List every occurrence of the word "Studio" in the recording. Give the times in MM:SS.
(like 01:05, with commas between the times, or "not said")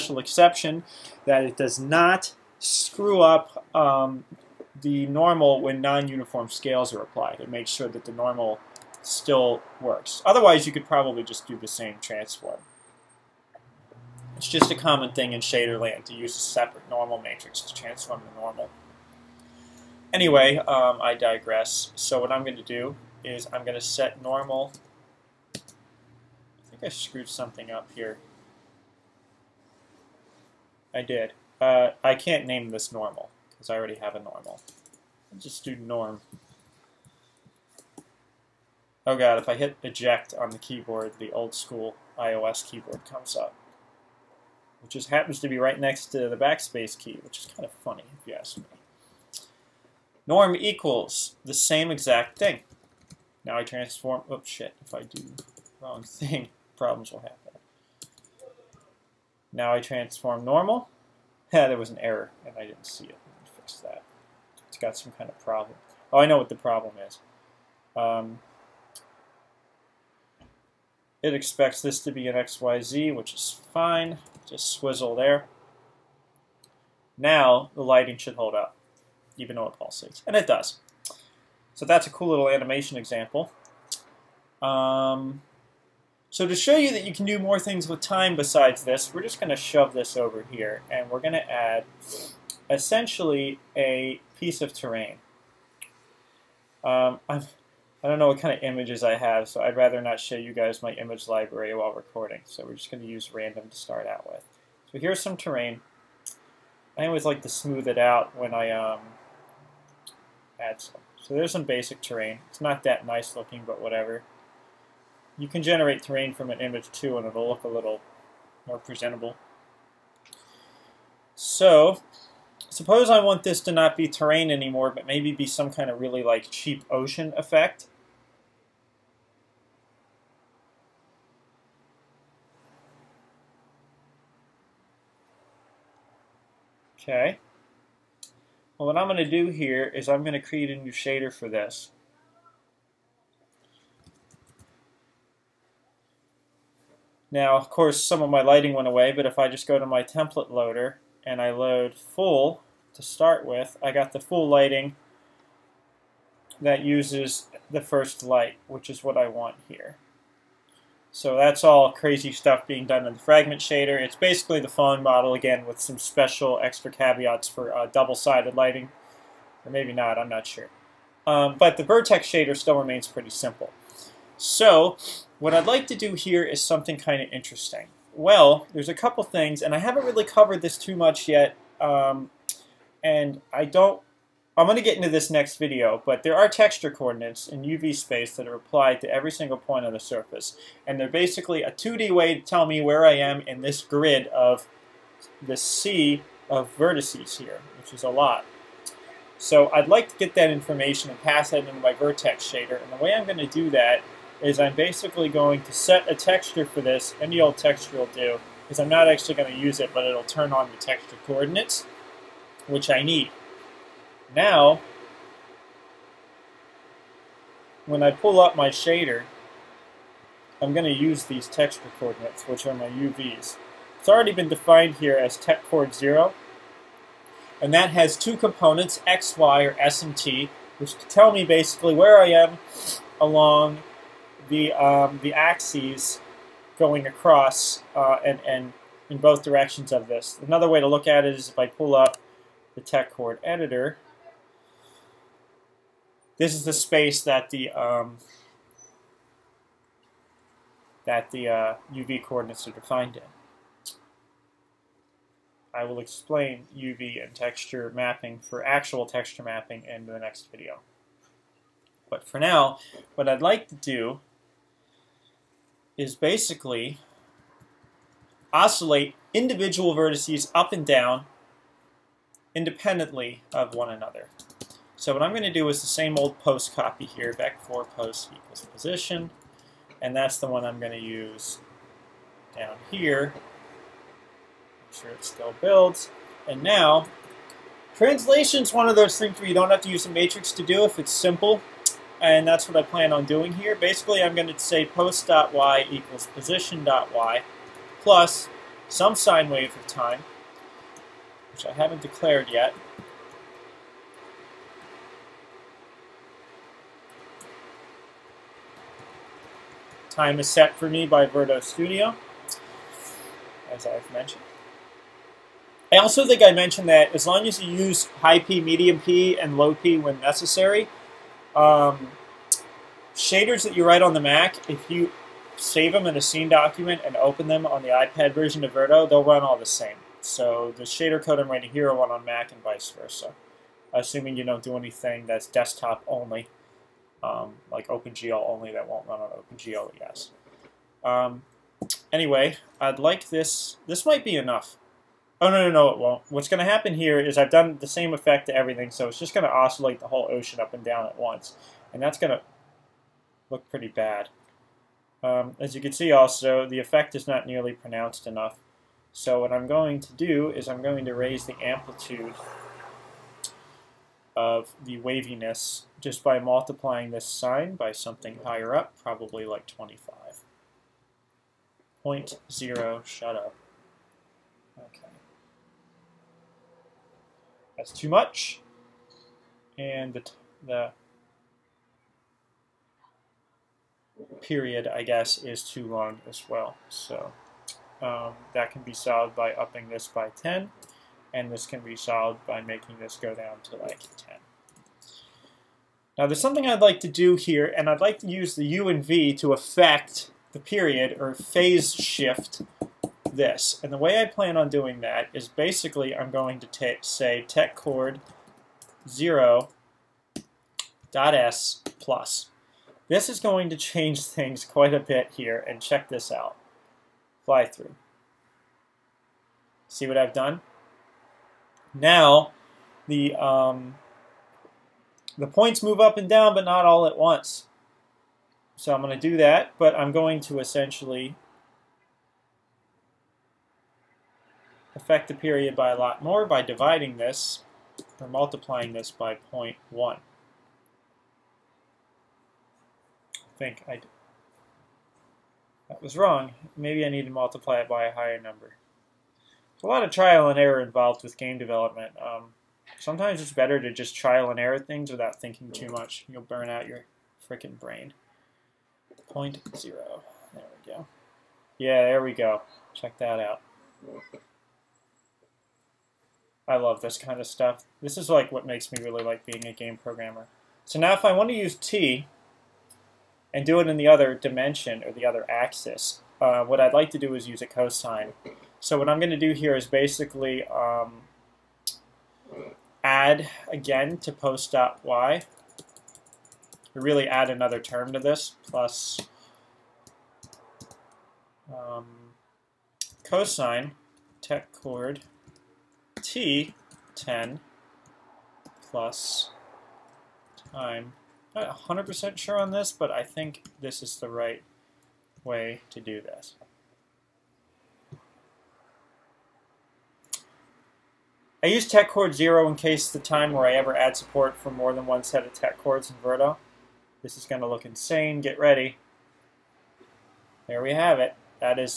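05:11.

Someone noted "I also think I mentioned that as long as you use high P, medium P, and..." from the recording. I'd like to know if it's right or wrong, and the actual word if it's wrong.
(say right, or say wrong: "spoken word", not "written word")
right.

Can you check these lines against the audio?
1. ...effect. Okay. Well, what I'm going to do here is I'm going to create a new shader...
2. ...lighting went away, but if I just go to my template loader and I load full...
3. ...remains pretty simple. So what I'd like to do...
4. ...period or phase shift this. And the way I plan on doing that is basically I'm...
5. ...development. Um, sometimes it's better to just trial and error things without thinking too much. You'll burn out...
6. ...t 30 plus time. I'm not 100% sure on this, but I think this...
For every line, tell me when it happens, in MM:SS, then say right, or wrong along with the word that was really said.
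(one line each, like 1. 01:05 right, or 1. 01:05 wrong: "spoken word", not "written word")
1. 02:07 right
2. 02:28 right
3. 02:52 right
4. 06:40 right
5. 07:31 right
6. 08:16 wrong: "10", not "30".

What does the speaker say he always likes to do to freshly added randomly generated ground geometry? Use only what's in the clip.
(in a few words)
smooth it out.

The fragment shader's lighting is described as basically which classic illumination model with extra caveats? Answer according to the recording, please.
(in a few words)
Phong model.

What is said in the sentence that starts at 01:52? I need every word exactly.
It's not that nice looking, but whatever.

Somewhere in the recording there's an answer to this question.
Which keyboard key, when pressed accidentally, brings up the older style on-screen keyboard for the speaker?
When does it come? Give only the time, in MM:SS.
00:39.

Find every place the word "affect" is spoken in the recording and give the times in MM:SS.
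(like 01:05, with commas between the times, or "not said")
06:39, 07:14.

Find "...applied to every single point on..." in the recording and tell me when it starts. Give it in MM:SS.
03:08.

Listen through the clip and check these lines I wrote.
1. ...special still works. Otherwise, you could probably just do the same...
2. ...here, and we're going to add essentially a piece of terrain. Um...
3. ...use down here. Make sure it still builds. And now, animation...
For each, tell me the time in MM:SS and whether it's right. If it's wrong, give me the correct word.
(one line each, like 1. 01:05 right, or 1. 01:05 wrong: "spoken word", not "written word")
1. 00:08 wrong: "normal", not "special"
2. 01:30 right
3. 04:40 wrong: "translation", not "animation".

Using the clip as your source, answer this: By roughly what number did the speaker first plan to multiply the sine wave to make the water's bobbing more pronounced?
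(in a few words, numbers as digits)
25.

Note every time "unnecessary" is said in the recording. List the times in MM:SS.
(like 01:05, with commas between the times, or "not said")
not said.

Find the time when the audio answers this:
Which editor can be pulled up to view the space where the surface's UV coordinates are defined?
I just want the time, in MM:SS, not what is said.
04:02.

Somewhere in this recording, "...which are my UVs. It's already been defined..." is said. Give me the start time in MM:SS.
03:42.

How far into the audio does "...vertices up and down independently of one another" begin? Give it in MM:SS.
04:29.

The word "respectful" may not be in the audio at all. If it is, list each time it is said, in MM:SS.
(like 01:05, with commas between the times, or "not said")
not said.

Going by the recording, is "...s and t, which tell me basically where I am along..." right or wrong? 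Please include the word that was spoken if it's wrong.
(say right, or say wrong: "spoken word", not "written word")
right.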